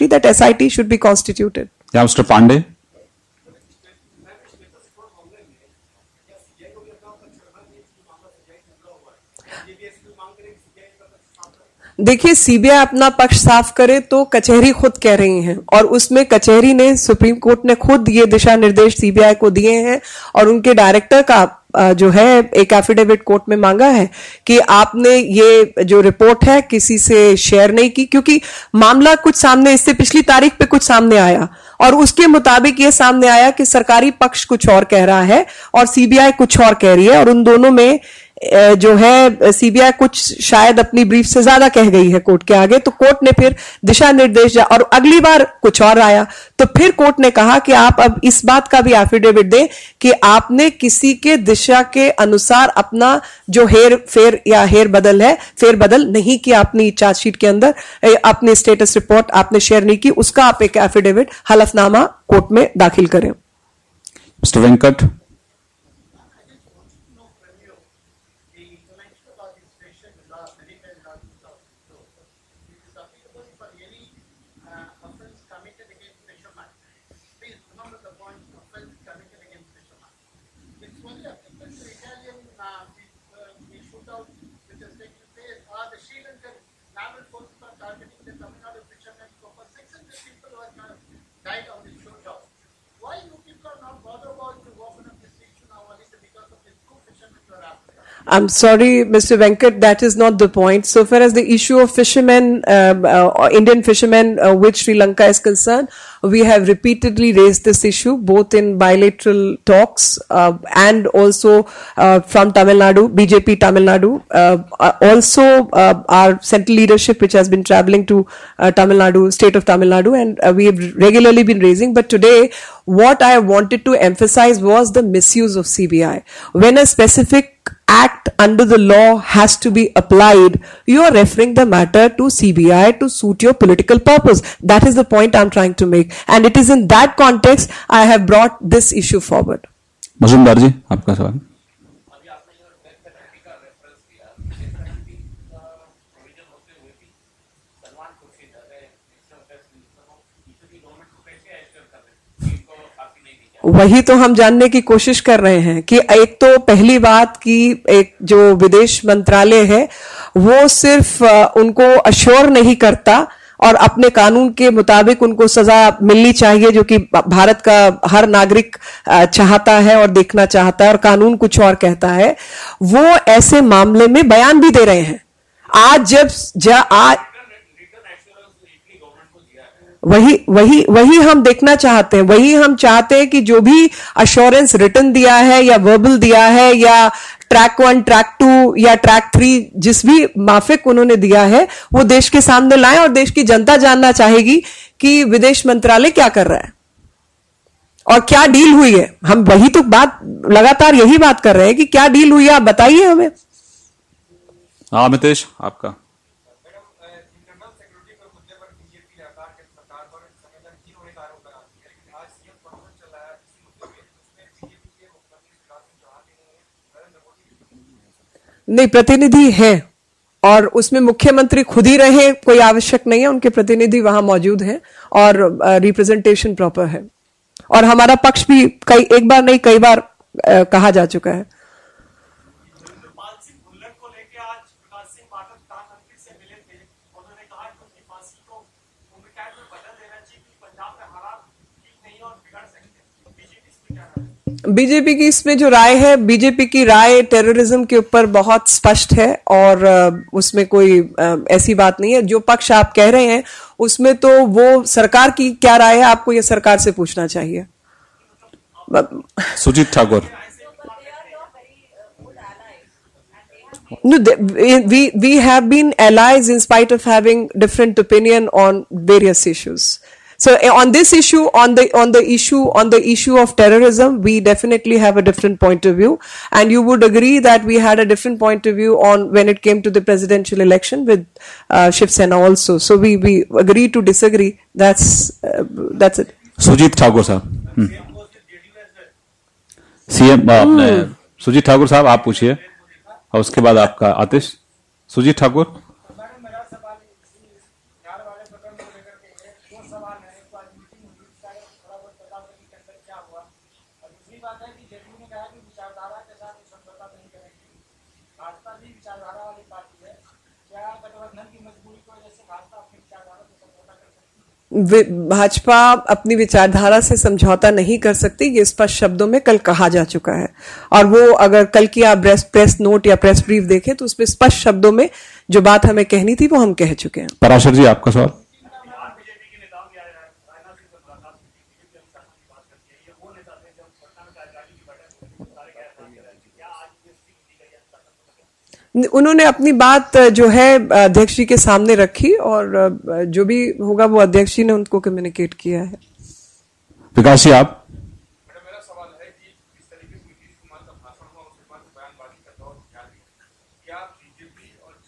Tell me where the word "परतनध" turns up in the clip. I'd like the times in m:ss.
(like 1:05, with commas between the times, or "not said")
3:38, 3:43.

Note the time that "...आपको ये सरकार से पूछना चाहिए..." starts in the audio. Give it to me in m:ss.
4:16.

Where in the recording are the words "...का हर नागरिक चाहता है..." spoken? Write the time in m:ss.
2:47.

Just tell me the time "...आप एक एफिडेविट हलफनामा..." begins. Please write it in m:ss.
1:00.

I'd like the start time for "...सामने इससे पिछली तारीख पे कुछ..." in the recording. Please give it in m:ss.
0:29.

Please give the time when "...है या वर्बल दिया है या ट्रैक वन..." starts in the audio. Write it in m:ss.
3:05.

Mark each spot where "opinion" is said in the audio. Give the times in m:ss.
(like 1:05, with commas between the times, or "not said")
4:28.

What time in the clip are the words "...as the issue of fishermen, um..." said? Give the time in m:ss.
1:41.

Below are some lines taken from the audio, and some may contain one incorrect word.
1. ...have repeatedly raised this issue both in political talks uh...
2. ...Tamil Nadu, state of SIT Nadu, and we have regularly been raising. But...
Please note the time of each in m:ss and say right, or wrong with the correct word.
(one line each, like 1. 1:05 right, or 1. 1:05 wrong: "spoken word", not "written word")
1. 1:46 wrong: "bilateral", not "political"
2. 1:58 wrong: "Tamil", not "SIT".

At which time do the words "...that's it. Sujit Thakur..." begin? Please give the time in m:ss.
4:46.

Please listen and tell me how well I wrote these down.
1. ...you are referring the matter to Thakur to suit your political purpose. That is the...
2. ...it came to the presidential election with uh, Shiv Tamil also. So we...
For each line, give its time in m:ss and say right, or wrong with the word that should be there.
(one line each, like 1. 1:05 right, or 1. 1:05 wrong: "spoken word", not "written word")
1. 2:10 wrong: "CBI", not "Thakur"
2. 4:39 wrong: "Sena", not "Tamil".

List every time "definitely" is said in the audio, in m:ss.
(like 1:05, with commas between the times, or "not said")
4:34.